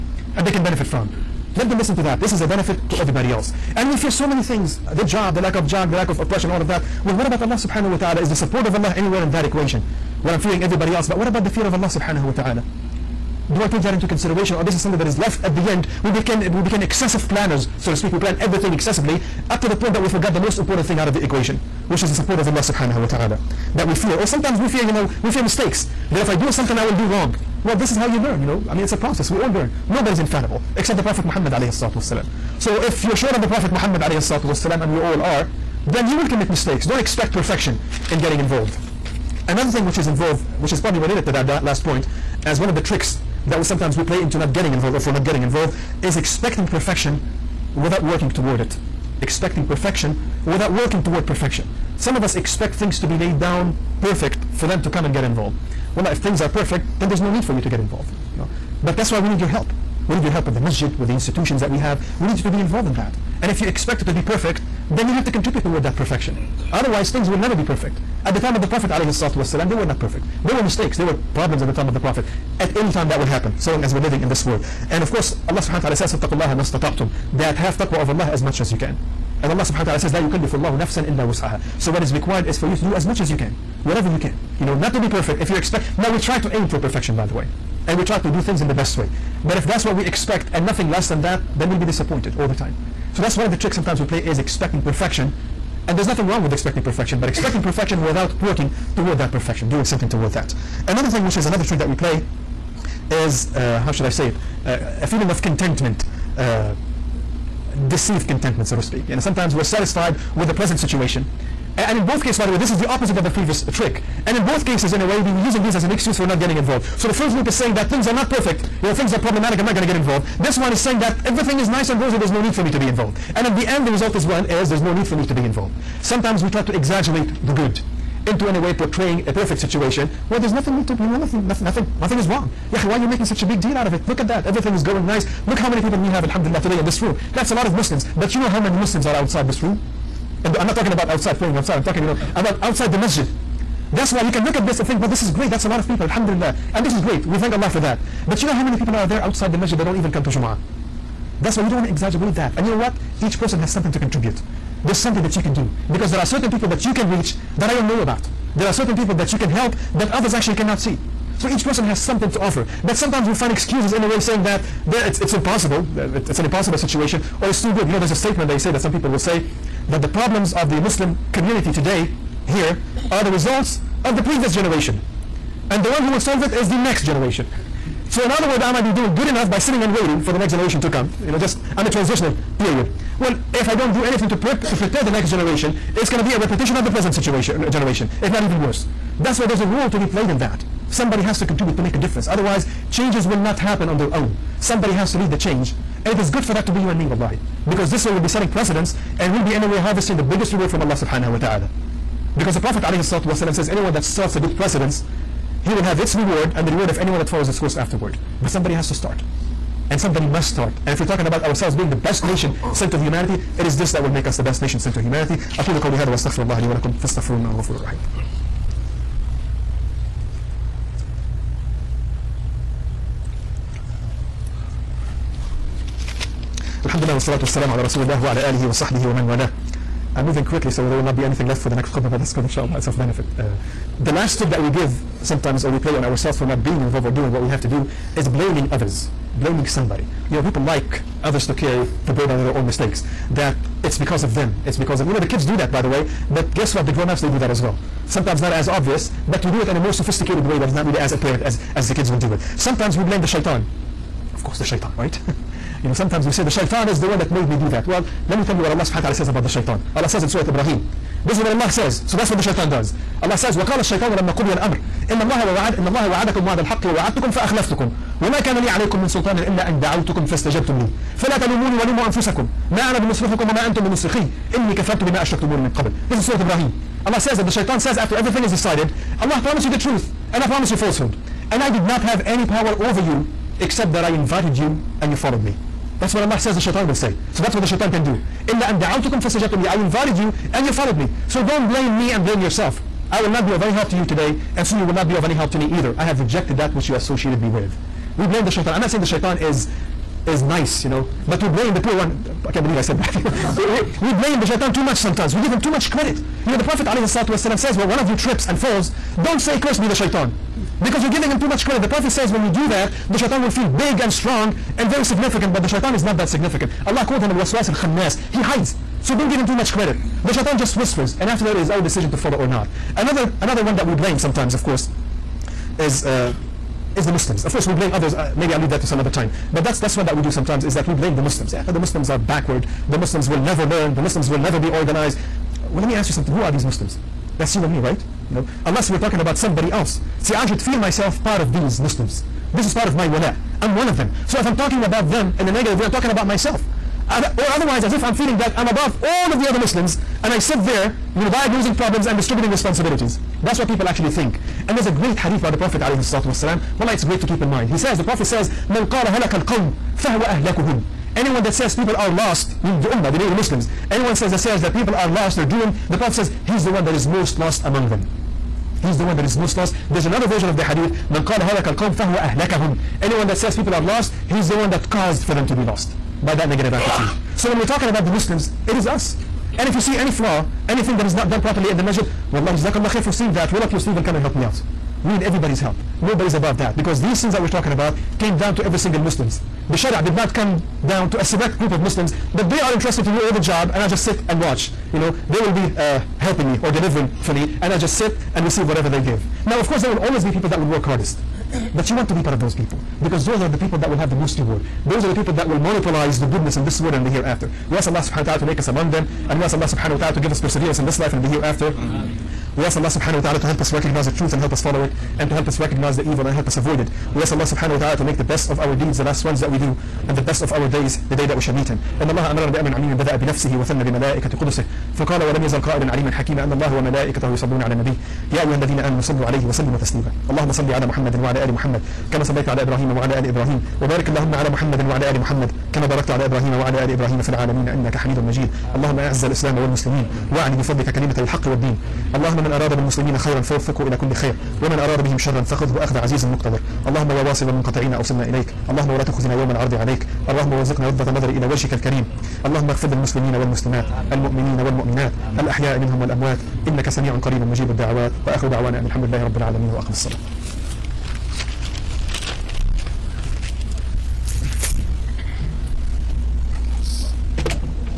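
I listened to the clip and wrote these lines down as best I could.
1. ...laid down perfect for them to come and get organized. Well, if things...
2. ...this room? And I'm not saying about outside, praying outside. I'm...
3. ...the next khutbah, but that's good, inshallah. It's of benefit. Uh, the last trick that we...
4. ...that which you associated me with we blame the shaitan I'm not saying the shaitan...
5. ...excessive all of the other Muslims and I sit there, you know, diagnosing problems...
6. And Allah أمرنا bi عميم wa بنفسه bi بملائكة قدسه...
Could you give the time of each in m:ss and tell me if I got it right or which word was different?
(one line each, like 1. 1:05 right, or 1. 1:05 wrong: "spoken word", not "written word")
1. 0:53 wrong: "involved", not "organized"
2. 2:19 wrong: "talking", not "saying"
3. 3:51 right
4. 4:56 right
5. 5:48 wrong: "above", not "excessive"
6. 7:01 right.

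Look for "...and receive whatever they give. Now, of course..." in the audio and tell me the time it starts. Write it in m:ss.
6:38.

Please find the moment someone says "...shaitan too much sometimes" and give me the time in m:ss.
5:04.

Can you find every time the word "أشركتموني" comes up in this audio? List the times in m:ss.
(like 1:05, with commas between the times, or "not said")
4:35.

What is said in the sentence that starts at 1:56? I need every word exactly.
So the first group is saying that things are not perfect, you know, things are problematic, I'm not going to get involved.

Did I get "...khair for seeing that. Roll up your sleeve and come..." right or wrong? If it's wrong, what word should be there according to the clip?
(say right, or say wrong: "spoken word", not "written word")
right.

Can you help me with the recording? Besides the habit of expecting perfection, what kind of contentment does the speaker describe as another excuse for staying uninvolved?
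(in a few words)
deceived contentment.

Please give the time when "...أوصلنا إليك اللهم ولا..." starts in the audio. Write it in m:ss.
7:27.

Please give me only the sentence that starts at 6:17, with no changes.
So when we're talking about the Muslims, it is us.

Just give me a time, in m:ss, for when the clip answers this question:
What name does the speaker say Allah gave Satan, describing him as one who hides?
5:17.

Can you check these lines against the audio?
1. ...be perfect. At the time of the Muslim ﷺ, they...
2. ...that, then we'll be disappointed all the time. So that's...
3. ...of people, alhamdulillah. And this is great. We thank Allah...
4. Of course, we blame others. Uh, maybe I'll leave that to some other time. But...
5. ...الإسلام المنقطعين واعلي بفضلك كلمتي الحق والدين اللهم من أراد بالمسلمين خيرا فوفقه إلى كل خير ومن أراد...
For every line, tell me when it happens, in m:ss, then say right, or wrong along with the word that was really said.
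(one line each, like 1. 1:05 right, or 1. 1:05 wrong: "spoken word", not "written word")
1. 1:07 wrong: "Prophet", not "Muslim"
2. 1:31 right
3. 2:25 right
4. 5:27 right
5. 7:19 wrong: "والمسلمين", not "المنقطعين".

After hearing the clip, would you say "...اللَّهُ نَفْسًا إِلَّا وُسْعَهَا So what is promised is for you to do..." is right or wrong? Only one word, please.
wrong.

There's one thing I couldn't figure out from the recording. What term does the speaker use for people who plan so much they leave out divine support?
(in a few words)
excessive planners.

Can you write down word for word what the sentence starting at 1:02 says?
We need you to be involved in that.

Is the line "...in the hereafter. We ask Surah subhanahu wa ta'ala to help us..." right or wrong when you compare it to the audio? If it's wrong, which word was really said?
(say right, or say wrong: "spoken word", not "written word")
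wrong: "Allah", not "Surah".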